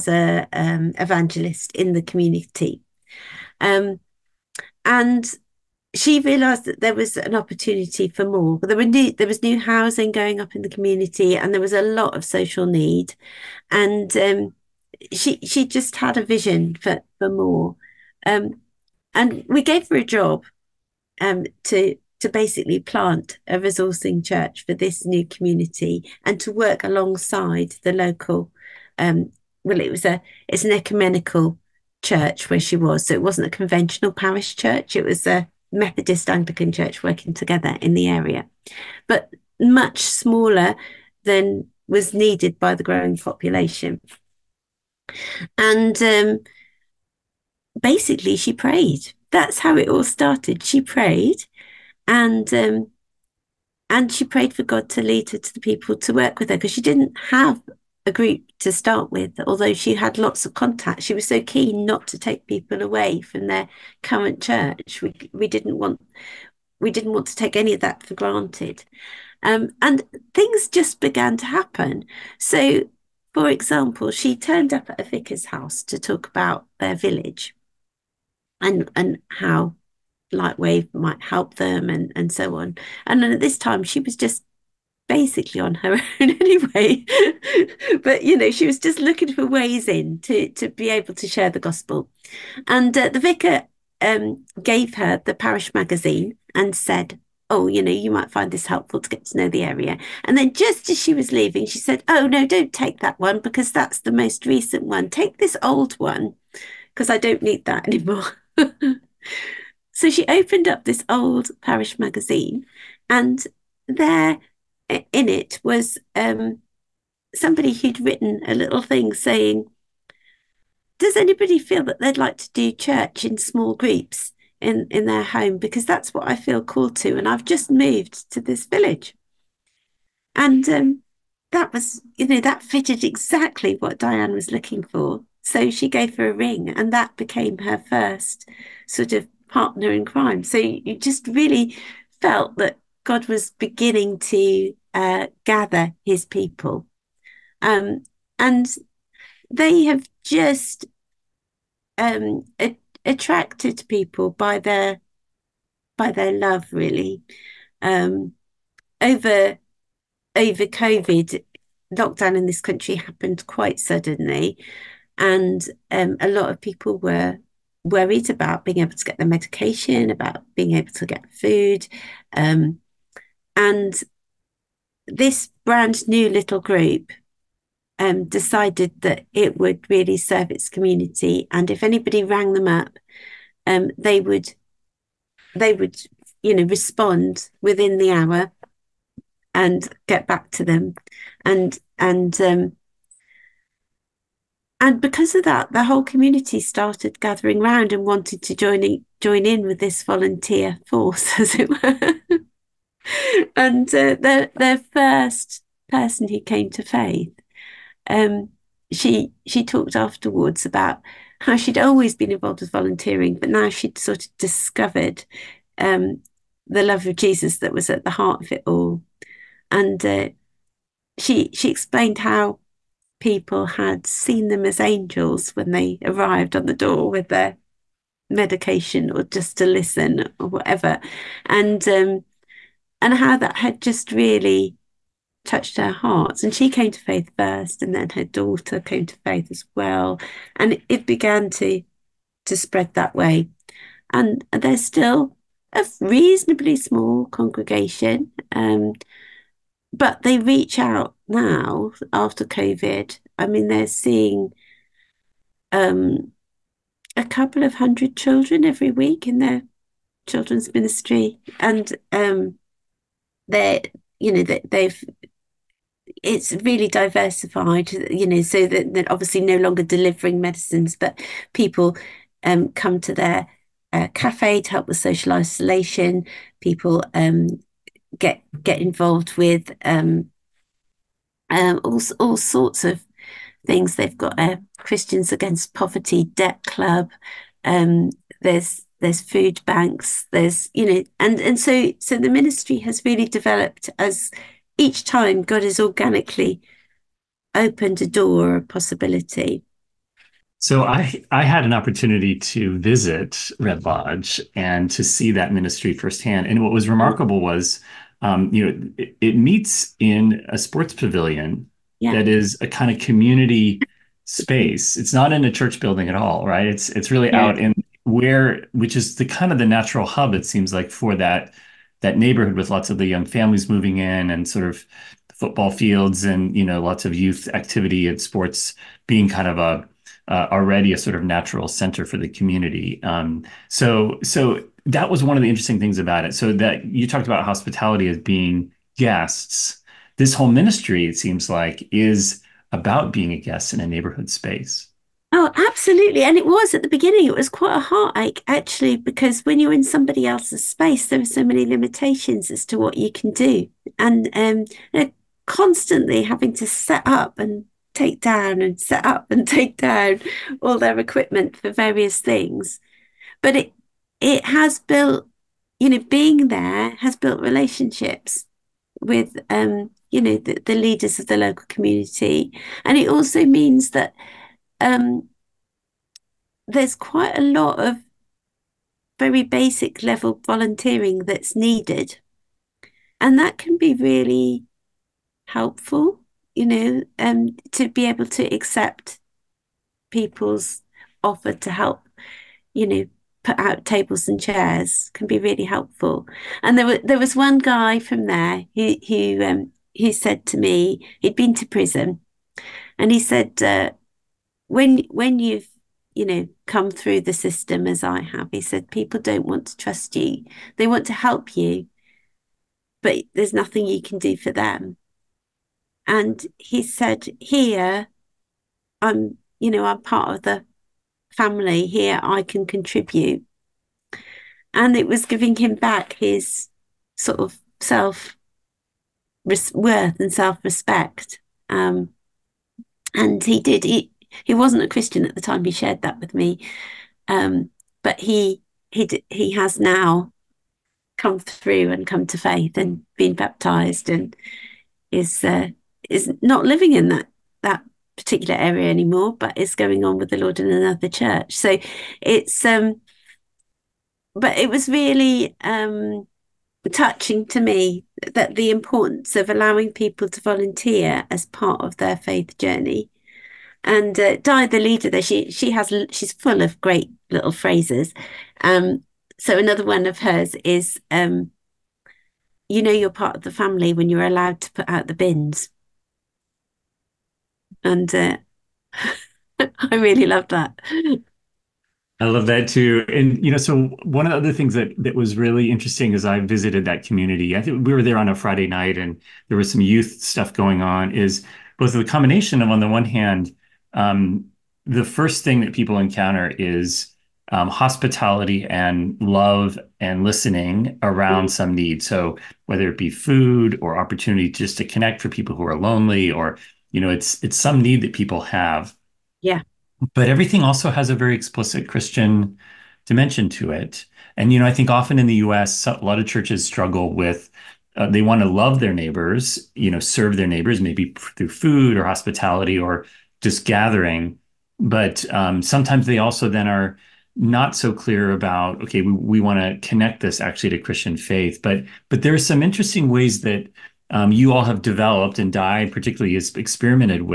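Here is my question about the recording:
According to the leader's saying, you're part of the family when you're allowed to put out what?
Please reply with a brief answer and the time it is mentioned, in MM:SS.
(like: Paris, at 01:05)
The bins, at 07:55.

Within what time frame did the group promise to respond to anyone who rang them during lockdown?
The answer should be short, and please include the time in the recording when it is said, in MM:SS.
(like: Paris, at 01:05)
Within the hour, at 03:07.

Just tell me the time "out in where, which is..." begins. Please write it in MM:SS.
05:17.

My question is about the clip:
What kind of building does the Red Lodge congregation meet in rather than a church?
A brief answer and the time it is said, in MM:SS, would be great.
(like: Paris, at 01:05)
A sports pavilion, at 05:10.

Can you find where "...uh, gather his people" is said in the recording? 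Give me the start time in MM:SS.
02:24.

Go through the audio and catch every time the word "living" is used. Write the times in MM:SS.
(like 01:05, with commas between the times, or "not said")
07:26.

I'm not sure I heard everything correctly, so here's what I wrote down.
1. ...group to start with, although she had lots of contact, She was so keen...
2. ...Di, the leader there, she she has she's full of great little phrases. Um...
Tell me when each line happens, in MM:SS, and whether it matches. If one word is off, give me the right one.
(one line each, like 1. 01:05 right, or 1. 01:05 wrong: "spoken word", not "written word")
1. 00:58 right
2. 07:44 right.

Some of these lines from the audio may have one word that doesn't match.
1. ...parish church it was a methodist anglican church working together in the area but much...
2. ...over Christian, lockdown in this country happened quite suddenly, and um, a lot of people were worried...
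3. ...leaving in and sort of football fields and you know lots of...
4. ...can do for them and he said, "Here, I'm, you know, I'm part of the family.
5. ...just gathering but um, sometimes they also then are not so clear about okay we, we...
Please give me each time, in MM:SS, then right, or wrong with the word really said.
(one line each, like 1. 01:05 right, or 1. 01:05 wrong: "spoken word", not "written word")
1. 00:34 right
2. 02:40 wrong: "COVID", not "Christian"
3. 05:23 wrong: "moving", not "leaving"
4. 06:54 right
5. 08:43 right.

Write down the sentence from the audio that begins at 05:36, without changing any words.
So that you talked about hospitality as being guests.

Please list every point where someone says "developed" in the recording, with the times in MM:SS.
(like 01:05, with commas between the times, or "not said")
04:53, 08:54.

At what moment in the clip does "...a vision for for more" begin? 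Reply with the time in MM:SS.
00:16.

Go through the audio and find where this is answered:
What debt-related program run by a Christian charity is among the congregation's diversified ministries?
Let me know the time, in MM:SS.
04:44.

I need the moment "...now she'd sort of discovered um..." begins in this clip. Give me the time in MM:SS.
03:33.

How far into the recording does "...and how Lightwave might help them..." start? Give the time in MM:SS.
01:18.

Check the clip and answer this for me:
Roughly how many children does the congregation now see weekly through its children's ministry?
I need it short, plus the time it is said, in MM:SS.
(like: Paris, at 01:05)
A couple of hundred, at 04:17.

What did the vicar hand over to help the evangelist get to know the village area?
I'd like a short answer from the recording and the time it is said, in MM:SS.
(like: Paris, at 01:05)
The parish magazine, at 01:35.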